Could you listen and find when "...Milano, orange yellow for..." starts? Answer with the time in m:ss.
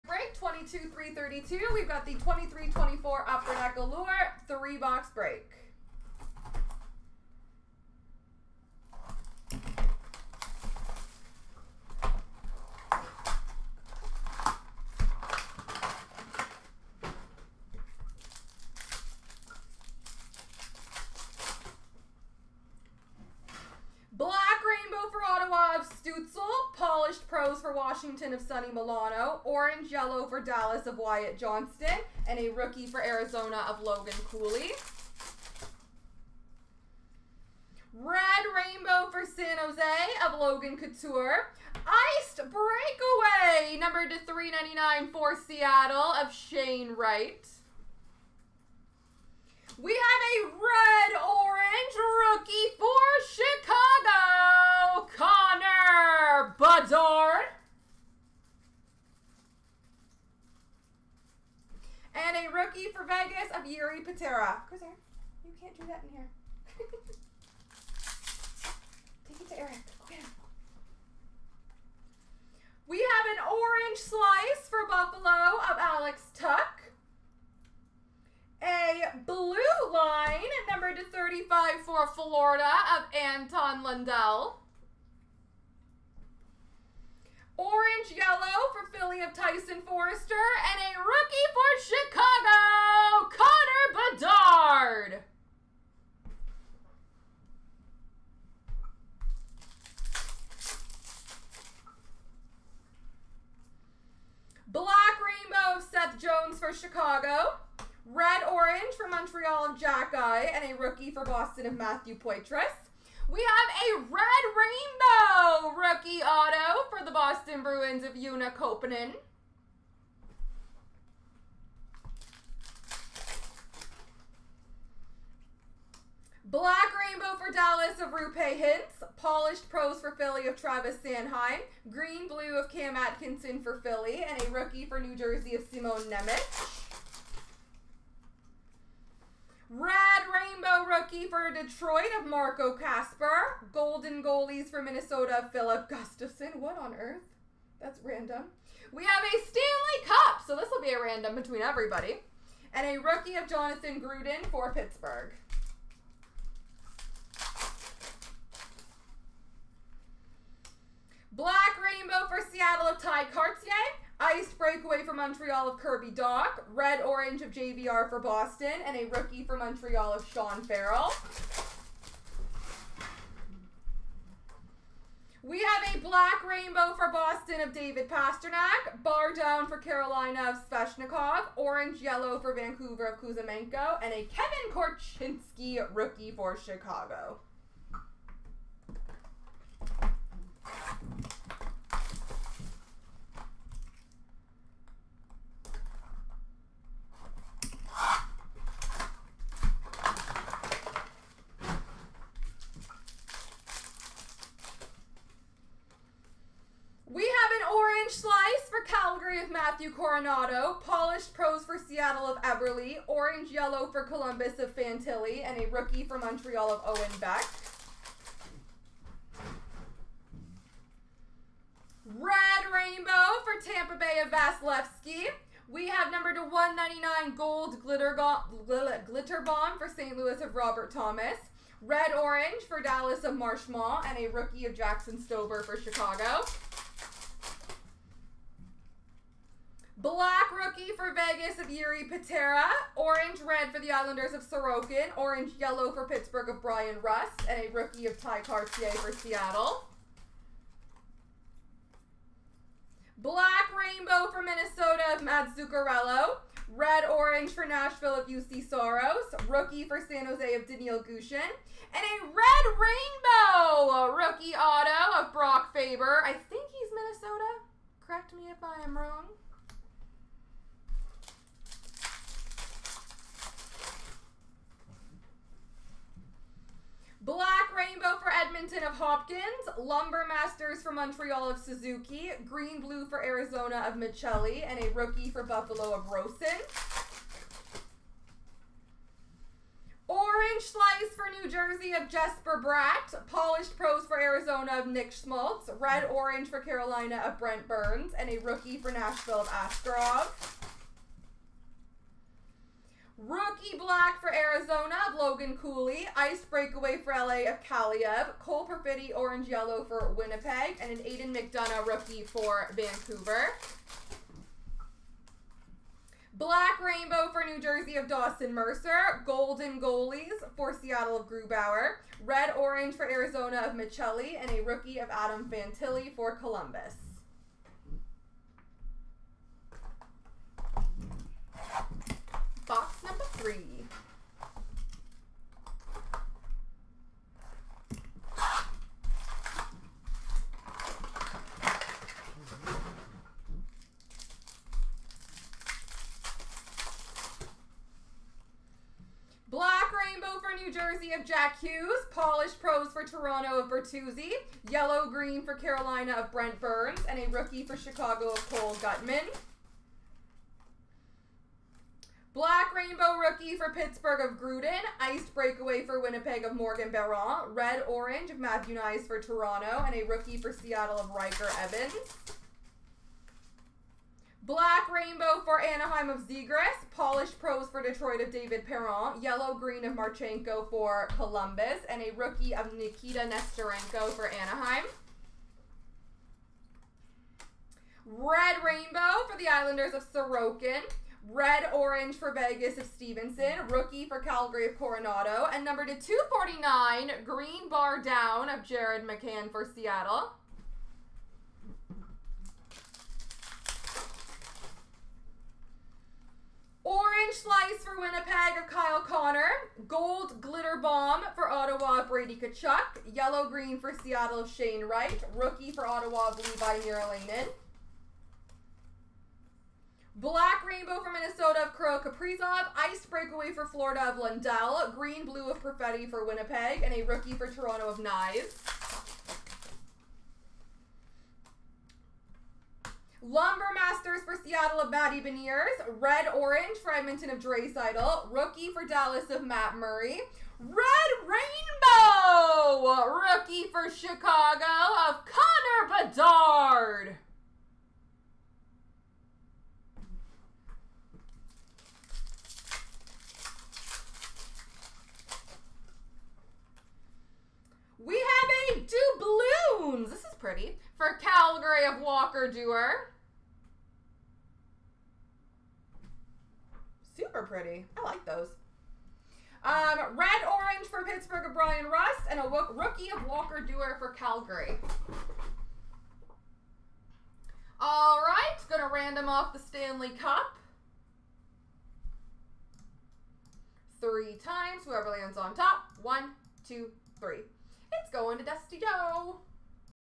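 0:28.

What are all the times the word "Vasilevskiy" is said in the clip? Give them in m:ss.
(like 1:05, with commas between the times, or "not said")
3:44.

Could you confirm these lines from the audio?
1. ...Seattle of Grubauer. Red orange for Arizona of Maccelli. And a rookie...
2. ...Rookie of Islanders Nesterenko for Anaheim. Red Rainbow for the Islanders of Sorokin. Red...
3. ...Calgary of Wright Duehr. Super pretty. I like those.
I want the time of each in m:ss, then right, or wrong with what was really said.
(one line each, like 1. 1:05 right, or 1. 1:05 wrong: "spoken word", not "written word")
1. 5:20 right
2. 6:22 wrong: "Nikita", not "Islanders"
3. 7:41 wrong: "Walker", not "Wright".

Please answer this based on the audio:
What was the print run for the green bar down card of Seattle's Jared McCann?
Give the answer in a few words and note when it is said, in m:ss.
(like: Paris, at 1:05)
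249, at 6:35.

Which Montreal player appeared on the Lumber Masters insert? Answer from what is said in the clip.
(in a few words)
Suzuki.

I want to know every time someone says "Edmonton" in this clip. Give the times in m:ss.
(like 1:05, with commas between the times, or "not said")
7:16.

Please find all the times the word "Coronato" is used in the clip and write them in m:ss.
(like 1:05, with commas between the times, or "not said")
3:29, 6:34.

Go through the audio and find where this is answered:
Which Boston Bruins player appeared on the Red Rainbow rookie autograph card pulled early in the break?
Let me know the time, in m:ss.
1:58.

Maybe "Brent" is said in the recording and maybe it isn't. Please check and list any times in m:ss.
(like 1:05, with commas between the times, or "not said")
4:57, 5:56.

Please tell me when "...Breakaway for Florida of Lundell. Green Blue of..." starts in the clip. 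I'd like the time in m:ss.
7:03.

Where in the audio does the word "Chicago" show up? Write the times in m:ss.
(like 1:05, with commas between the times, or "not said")
0:55, 3:06, 3:55, 5:57, 7:23.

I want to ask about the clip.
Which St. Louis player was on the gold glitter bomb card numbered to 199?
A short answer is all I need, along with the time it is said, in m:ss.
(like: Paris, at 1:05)
Robert Thomas, at 3:50.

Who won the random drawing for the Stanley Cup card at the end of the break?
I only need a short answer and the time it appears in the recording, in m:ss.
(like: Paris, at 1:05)
Dusty Joe, at 8:08.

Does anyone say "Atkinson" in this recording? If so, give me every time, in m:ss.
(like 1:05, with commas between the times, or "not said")
2:12.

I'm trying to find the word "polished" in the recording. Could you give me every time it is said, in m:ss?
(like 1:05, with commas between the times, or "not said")
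2:09, 3:30, 4:53, 5:52, 6:16.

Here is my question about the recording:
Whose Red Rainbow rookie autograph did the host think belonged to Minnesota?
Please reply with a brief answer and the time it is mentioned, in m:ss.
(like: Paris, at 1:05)
Brock Faber, at 4:25.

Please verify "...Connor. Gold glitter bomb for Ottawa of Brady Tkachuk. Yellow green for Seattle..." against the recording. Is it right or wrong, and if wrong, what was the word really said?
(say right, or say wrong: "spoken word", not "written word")
right.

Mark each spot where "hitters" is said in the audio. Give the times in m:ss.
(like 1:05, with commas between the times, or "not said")
not said.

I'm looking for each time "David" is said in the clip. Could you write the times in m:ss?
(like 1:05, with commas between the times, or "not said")
2:57, 6:18.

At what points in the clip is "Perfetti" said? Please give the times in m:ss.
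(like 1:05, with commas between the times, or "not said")
5:08, 7:05.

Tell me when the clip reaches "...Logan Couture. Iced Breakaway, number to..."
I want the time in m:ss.
0:40.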